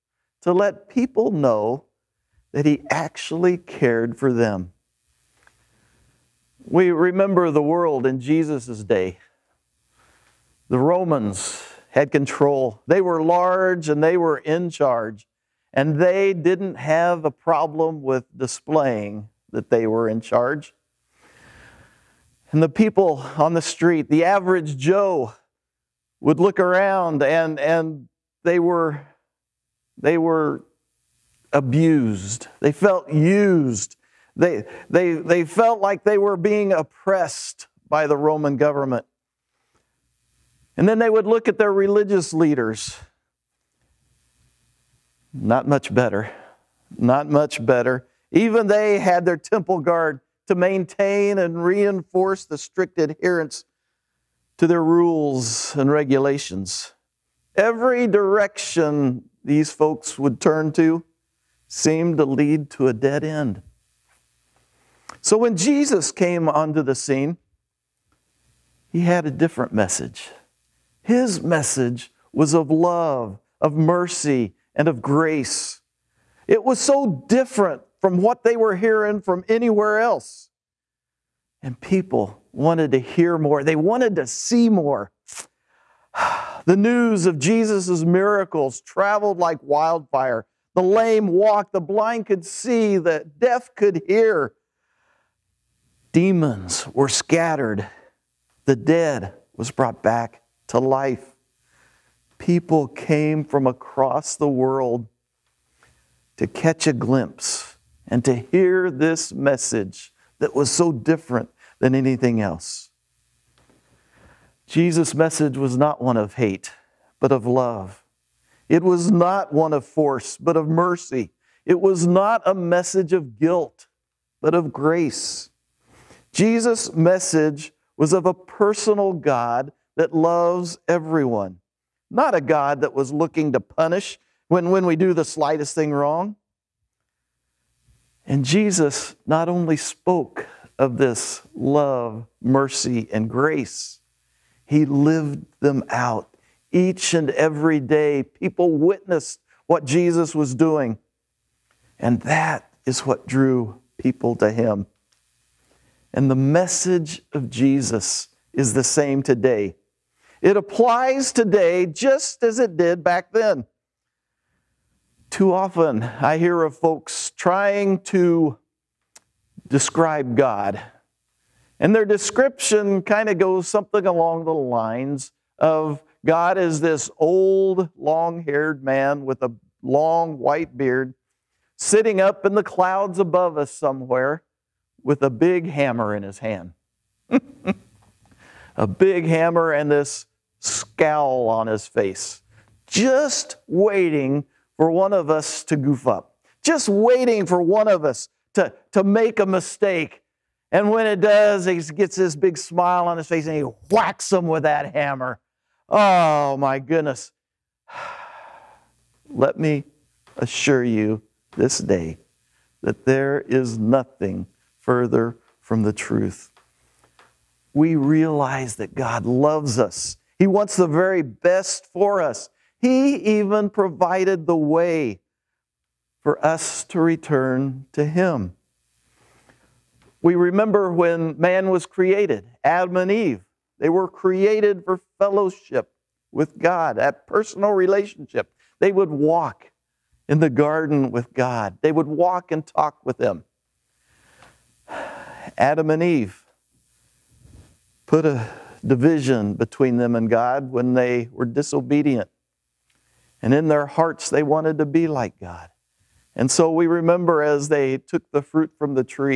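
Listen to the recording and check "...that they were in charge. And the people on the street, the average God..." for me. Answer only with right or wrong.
wrong.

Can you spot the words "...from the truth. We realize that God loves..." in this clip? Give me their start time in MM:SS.
03:35.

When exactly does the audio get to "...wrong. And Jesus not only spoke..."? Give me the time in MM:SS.
02:15.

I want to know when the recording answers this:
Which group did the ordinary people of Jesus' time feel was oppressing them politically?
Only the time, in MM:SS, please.
00:38.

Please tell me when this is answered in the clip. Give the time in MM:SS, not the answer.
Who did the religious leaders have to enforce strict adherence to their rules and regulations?
00:49.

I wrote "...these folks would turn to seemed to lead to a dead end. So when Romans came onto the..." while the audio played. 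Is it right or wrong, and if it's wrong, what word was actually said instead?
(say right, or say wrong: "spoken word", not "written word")
wrong: "Jesus", not "Romans".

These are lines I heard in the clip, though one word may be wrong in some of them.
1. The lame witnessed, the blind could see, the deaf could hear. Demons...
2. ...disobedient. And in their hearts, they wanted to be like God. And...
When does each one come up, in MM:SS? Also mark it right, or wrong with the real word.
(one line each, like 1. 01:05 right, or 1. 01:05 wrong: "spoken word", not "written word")
1. 01:30 wrong: "walked", not "witnessed"
2. 04:11 right.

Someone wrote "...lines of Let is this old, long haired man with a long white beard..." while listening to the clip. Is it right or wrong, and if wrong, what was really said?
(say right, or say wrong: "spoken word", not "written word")
wrong: "God", not "Let".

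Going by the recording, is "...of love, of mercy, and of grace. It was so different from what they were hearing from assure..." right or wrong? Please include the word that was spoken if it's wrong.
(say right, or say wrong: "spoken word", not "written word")
wrong: "anywhere", not "assure".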